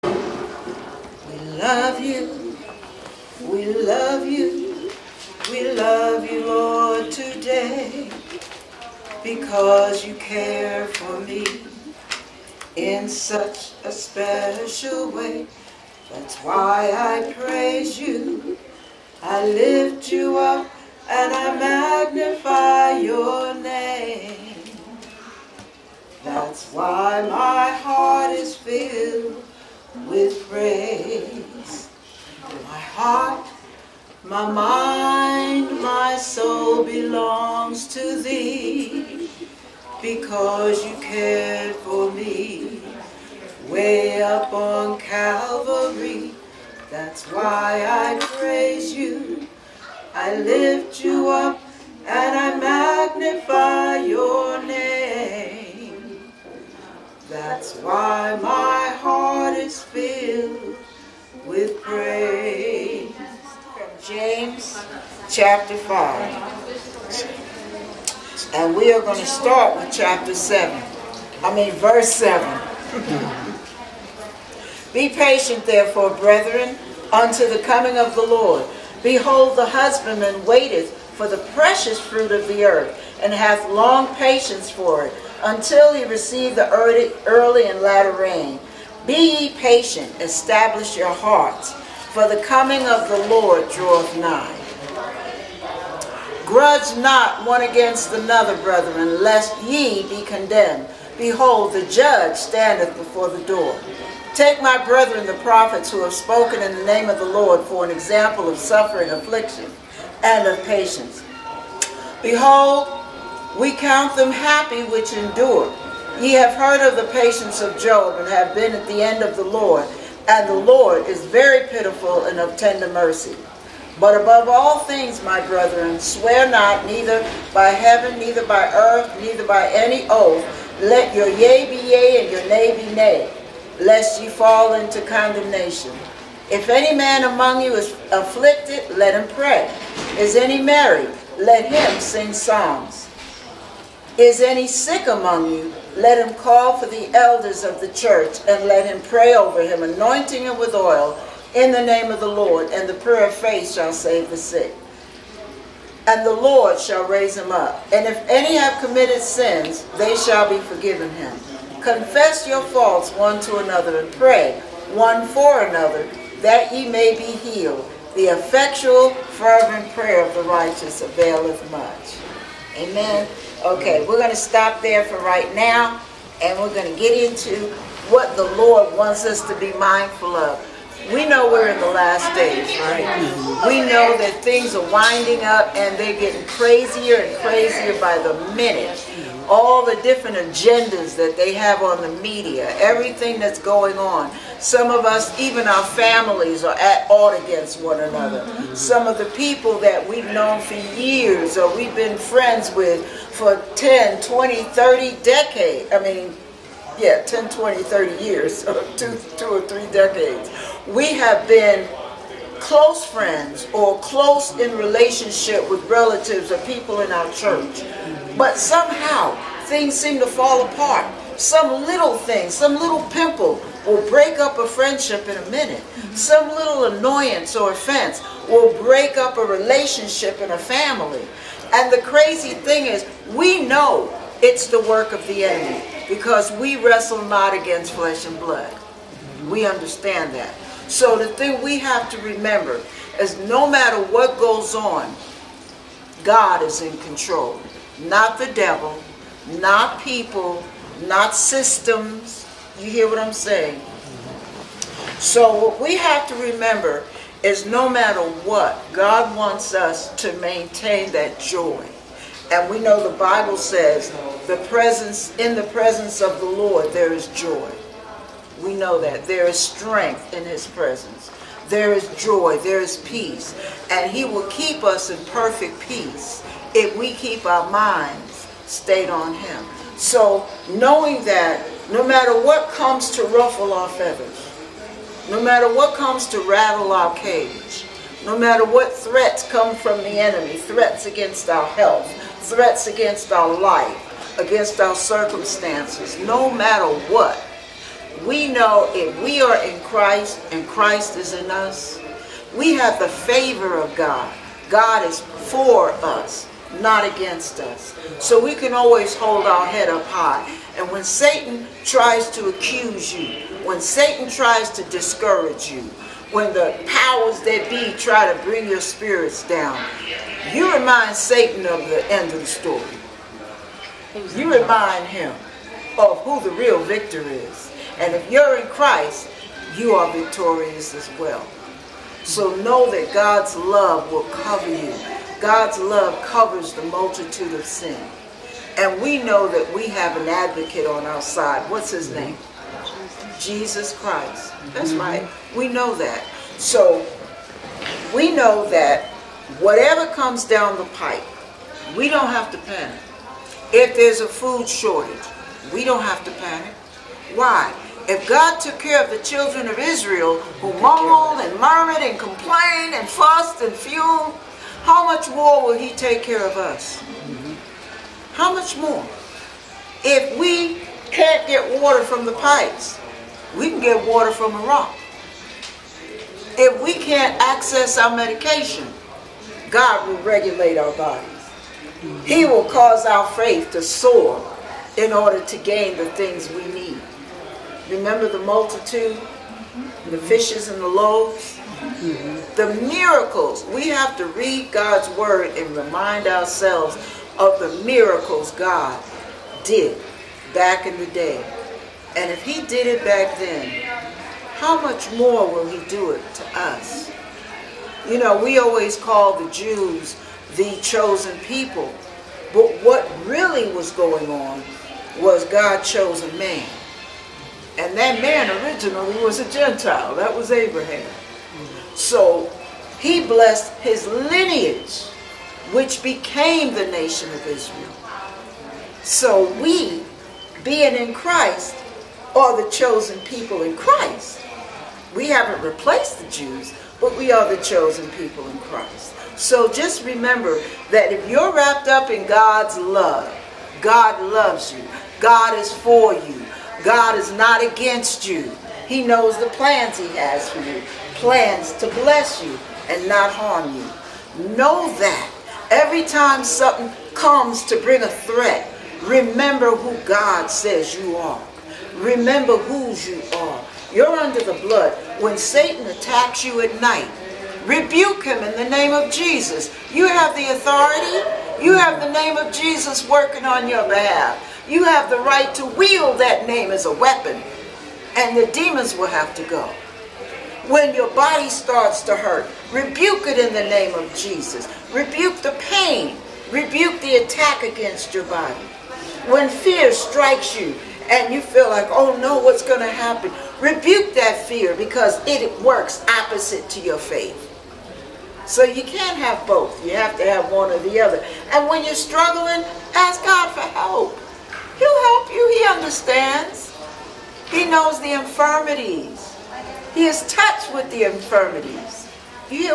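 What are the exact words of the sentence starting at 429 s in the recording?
So we, being in Christ, are the chosen people in Christ.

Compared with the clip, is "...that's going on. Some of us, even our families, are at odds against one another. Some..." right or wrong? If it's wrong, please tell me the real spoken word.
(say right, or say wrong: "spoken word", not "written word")
right.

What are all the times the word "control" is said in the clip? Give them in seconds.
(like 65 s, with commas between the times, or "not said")
247 s.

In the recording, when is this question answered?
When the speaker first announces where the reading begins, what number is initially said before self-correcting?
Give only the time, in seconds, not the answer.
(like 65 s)
69 s.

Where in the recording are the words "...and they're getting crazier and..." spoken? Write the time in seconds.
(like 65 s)
185 s.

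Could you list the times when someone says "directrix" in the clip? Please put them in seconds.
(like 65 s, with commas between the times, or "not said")
not said.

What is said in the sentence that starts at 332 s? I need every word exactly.
So know that God's love will cover you.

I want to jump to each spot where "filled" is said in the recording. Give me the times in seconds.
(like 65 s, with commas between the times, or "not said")
28 s, 59 s.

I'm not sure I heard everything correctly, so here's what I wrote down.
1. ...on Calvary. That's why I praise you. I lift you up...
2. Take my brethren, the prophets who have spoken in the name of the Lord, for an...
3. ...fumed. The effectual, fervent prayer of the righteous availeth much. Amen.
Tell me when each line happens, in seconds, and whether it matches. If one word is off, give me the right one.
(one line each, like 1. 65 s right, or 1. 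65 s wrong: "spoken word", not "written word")
1. 44 s right
2. 104 s right
3. 167 s wrong: "healed", not "fumed".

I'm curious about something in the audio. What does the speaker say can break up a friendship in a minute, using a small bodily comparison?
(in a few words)
some little pimple.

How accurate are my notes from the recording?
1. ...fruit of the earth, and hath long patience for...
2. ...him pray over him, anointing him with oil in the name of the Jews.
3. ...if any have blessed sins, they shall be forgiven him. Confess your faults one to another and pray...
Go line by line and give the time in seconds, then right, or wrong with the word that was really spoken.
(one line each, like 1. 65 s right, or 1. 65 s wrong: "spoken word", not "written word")
1. 82 s right
2. 148 s wrong: "Lord", not "Jews"
3. 158 s wrong: "committed", not "blessed".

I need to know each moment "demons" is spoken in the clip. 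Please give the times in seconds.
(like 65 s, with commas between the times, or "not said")
478 s.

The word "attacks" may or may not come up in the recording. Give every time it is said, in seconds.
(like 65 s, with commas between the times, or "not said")
465 s, 487 s.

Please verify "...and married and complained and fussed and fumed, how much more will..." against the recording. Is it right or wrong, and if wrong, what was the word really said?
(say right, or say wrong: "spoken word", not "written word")
wrong: "murmured", not "married".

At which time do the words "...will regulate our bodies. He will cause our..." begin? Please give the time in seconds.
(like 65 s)
380 s.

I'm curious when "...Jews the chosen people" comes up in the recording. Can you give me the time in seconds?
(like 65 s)
409 s.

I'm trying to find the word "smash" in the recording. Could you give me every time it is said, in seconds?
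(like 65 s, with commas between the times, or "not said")
not said.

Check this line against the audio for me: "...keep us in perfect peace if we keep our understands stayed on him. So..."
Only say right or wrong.
wrong.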